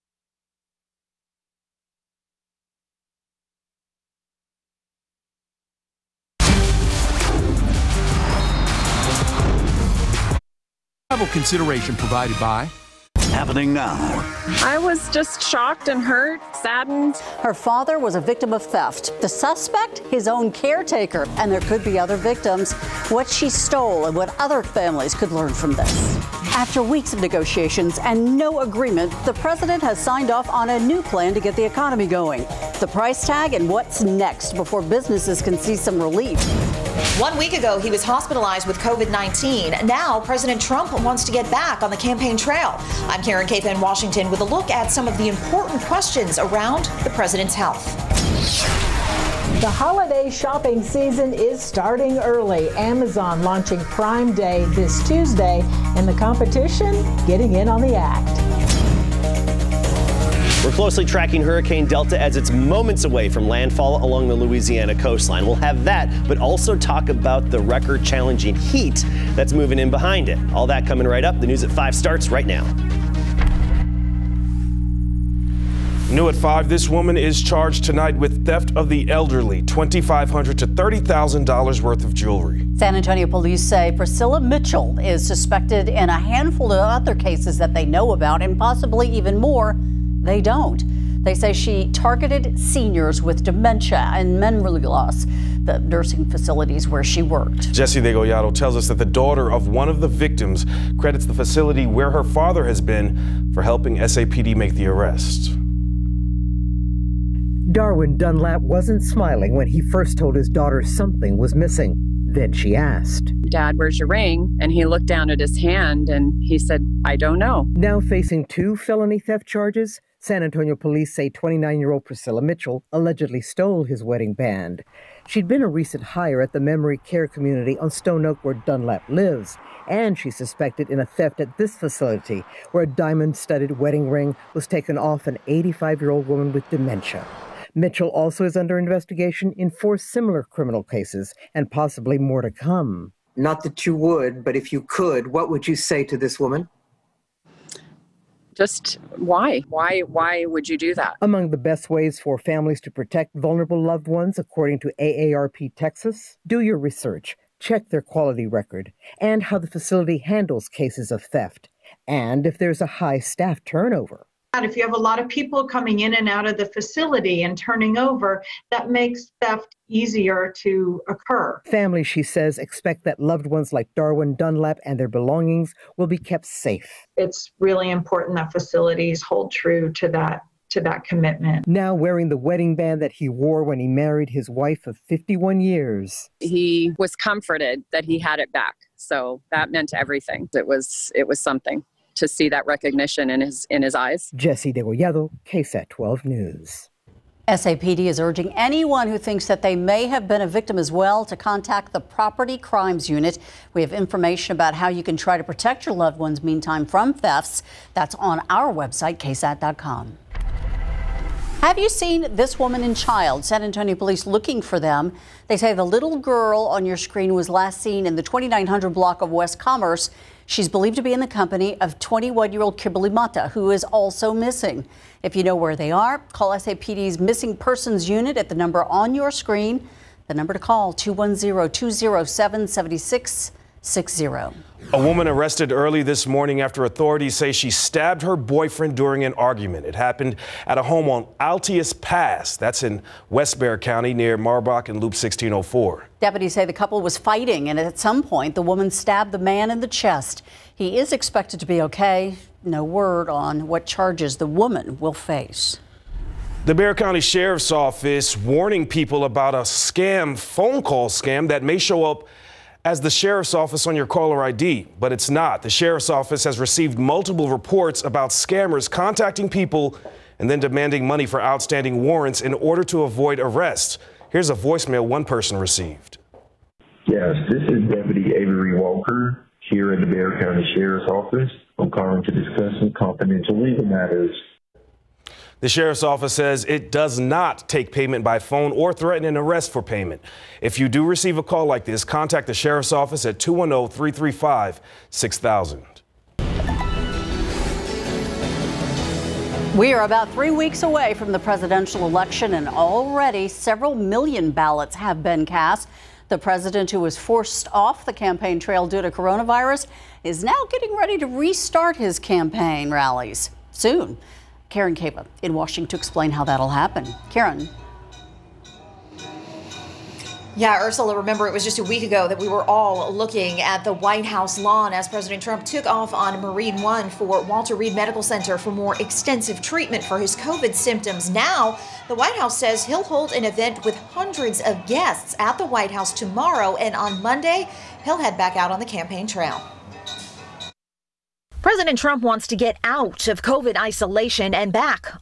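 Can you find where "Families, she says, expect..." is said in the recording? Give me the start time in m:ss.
2:51.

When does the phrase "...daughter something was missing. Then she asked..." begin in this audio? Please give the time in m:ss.
1:50.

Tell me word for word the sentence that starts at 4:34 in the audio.
Here's a voicemail one person received.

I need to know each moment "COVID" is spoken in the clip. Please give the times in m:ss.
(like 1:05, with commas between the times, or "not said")
0:38, 5:30, 5:43.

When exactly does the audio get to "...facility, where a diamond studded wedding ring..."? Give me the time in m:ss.
2:11.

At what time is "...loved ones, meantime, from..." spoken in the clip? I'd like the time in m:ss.
3:25.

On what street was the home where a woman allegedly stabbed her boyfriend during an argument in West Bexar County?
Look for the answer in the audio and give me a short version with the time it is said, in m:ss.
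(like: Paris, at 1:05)
Altius Pass, at 4:01.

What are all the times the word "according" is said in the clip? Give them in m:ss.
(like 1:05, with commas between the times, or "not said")
2:34.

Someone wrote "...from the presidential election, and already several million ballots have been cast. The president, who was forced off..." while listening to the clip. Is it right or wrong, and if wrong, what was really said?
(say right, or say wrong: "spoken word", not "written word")
right.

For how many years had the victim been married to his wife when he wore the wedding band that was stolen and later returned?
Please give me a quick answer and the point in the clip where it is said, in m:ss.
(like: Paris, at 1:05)
51, at 3:05.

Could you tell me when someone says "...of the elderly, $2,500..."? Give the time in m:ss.
1:18.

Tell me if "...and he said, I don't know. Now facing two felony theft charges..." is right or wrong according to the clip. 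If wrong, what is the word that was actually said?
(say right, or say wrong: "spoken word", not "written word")
right.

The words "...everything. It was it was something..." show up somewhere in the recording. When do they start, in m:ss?
3:09.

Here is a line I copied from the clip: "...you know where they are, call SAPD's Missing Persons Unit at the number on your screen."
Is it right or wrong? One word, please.
right.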